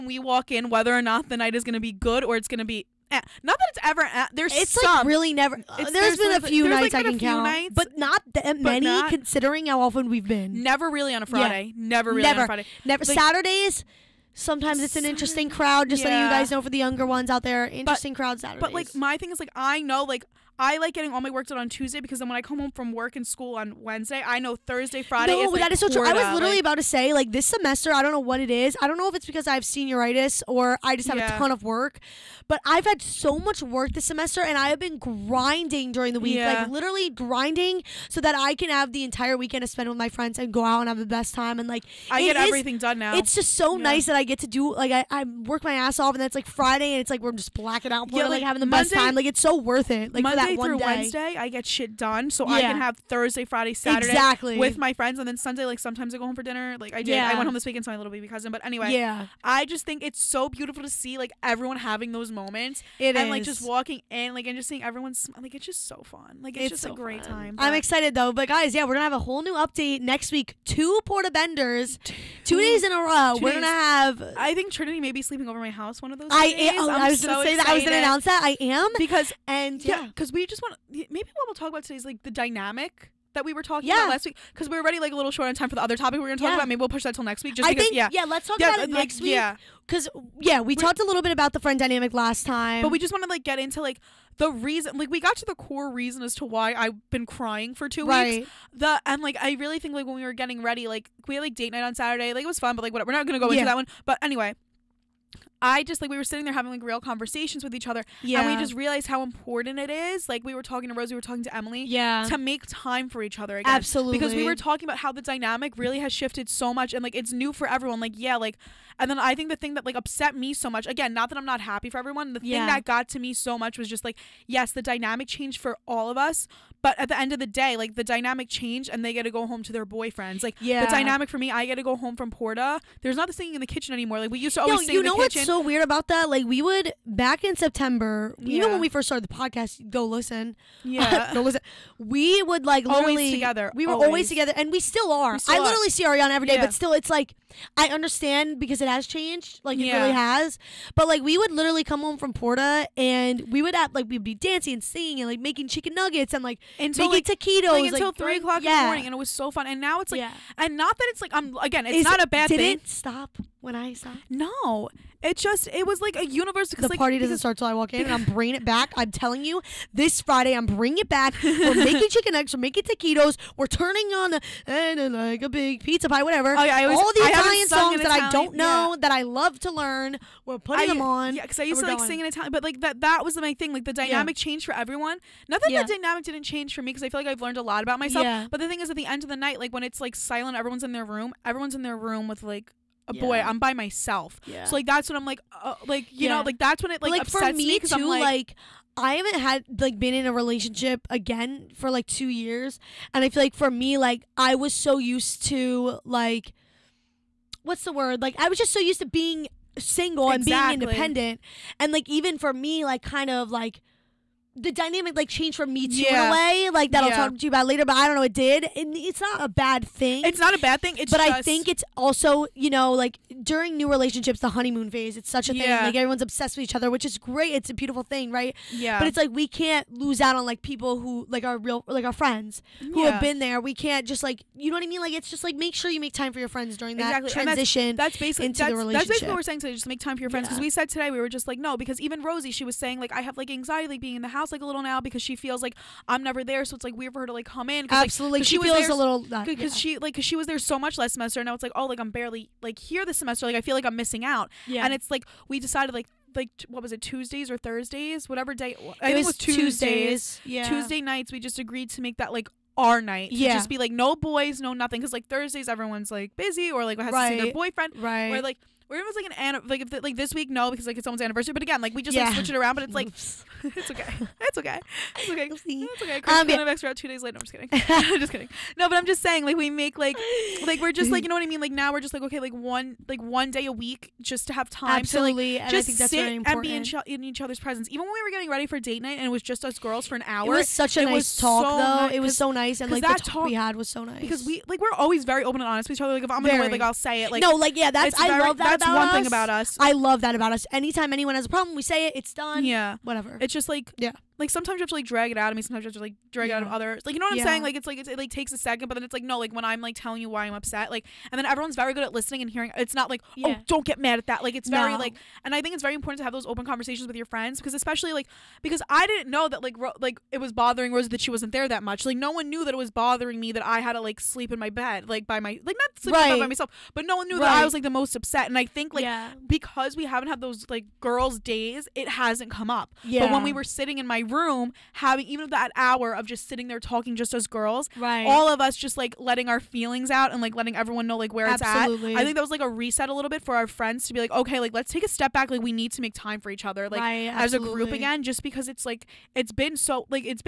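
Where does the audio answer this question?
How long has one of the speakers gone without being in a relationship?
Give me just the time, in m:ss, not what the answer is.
3:22.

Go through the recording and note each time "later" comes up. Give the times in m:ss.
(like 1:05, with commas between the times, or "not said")
3:37, 4:37.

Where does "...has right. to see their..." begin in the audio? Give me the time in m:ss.
4:26.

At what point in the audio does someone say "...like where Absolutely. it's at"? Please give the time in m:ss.
5:41.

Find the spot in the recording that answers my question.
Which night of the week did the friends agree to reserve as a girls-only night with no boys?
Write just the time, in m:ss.
4:20.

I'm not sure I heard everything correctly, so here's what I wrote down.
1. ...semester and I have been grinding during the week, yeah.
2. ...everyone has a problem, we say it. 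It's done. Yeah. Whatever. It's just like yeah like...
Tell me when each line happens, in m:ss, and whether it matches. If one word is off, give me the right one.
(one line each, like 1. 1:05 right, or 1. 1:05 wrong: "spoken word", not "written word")
1. 0:34 right
2. 5:01 wrong: "anyone", not "everyone".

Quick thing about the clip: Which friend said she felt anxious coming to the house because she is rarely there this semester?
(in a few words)
Rosie.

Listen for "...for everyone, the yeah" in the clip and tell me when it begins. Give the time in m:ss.
2:01.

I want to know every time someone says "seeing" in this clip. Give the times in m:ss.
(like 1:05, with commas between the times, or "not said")
1:04.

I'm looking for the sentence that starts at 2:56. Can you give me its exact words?
Oh, yeah, I always, All the I Italian songs that Italian, I don't know yeah.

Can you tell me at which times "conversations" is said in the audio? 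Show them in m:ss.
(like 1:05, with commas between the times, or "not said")
1:47, 5:16.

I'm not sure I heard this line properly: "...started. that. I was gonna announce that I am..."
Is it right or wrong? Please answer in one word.
wrong.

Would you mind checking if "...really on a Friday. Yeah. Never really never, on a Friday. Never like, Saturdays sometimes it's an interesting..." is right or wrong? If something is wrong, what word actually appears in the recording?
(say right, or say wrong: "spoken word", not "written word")
right.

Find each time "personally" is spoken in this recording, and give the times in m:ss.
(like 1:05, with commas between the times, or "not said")
not said.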